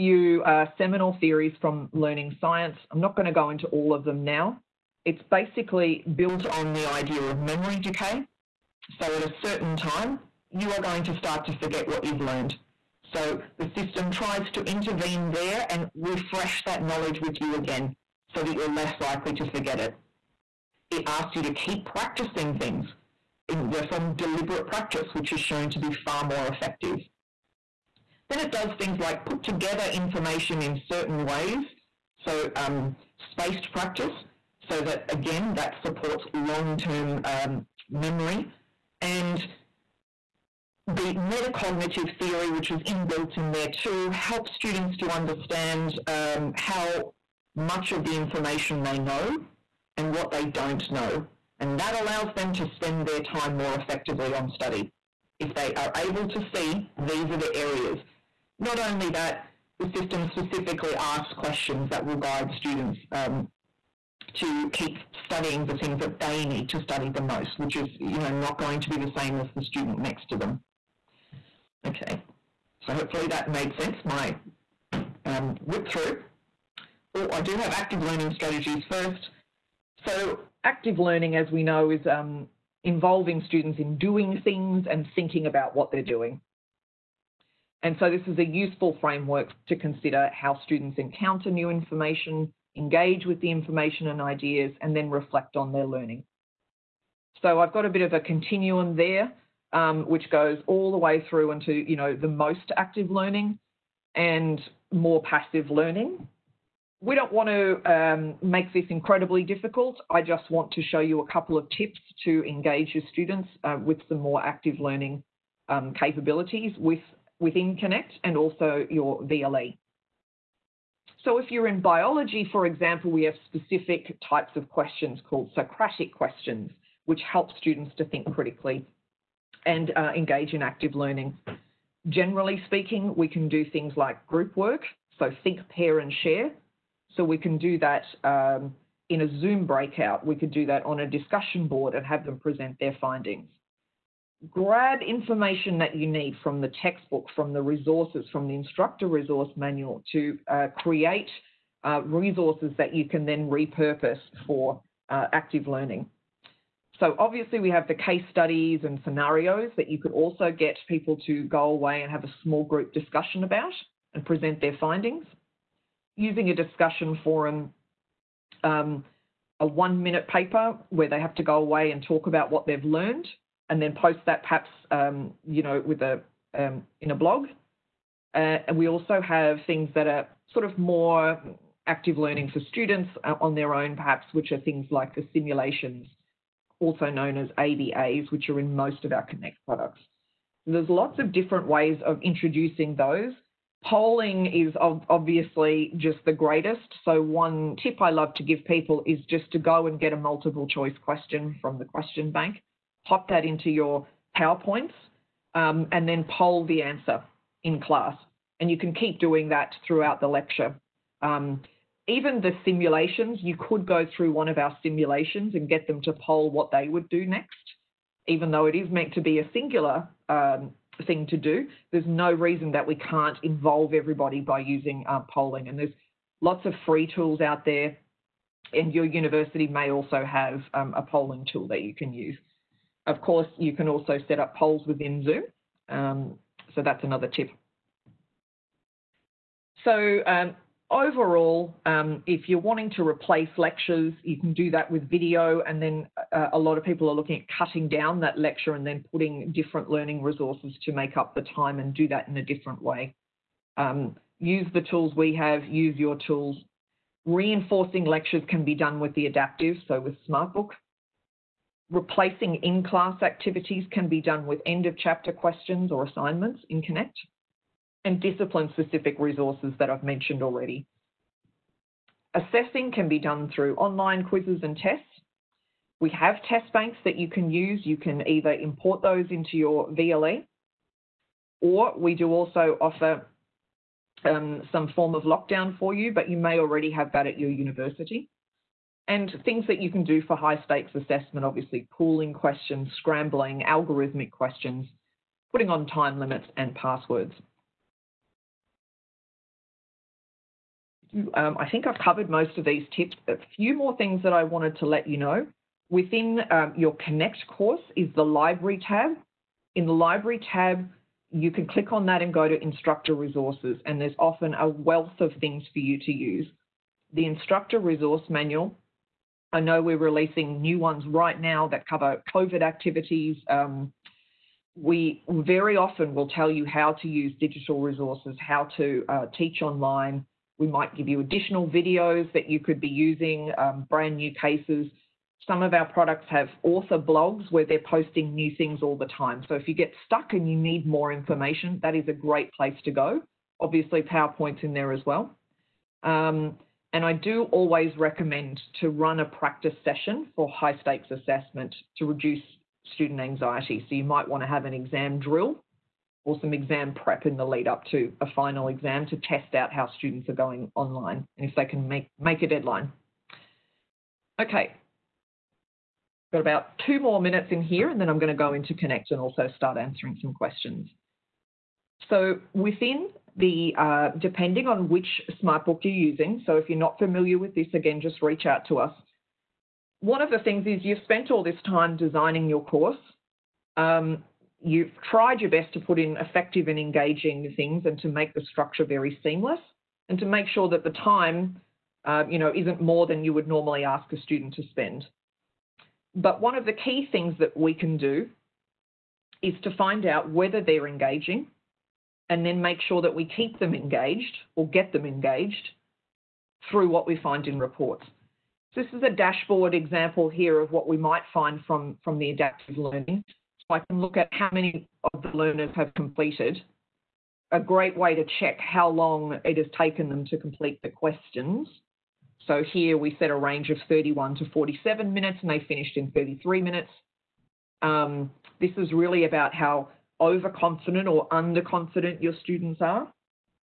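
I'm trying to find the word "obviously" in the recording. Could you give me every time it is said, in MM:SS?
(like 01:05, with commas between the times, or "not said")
02:37, 03:14, 04:51, 05:43.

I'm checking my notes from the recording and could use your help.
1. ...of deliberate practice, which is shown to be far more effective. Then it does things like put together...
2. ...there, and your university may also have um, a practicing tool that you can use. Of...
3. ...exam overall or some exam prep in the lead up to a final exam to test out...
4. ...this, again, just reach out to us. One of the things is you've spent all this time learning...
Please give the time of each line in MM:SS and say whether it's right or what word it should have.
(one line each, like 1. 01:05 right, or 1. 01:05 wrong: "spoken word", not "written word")
1. 00:24 right
2. 03:47 wrong: "polling", not "practicing"
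3. 05:54 wrong: "drill", not "overall"
4. 06:17 wrong: "designing", not "learning".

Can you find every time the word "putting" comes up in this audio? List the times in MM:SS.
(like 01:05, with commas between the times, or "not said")
04:09, 04:55.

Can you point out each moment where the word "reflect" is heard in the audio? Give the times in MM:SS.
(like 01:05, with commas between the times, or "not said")
01:35.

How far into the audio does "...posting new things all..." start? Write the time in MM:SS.
05:37.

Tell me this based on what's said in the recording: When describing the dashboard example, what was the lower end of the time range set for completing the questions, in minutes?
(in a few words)
31.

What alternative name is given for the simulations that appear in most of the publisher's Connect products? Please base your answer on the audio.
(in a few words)
ABAs.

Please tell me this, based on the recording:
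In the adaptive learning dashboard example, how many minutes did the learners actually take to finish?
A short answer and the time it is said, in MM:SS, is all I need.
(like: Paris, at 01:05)
33 minutes, at 07:06.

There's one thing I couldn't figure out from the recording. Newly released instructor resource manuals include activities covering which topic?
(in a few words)
COVID.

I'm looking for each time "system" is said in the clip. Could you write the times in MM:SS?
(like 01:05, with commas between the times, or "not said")
00:13, 00:59.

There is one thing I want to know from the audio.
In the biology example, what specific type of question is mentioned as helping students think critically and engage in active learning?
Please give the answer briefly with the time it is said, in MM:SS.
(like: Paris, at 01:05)
Socratic questions, at 02:05.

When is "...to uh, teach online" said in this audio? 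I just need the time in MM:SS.
05:28.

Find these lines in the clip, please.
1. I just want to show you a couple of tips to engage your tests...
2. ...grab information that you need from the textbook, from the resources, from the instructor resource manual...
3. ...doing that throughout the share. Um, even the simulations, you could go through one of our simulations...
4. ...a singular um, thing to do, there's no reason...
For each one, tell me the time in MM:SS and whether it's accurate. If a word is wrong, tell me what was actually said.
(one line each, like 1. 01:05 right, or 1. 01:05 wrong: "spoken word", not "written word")
1. 01:50 wrong: "students", not "tests"
2. 02:24 right
3. 03:29 wrong: "lecture", not "share"
4. 03:39 right.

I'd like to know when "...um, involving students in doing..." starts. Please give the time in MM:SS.
01:22.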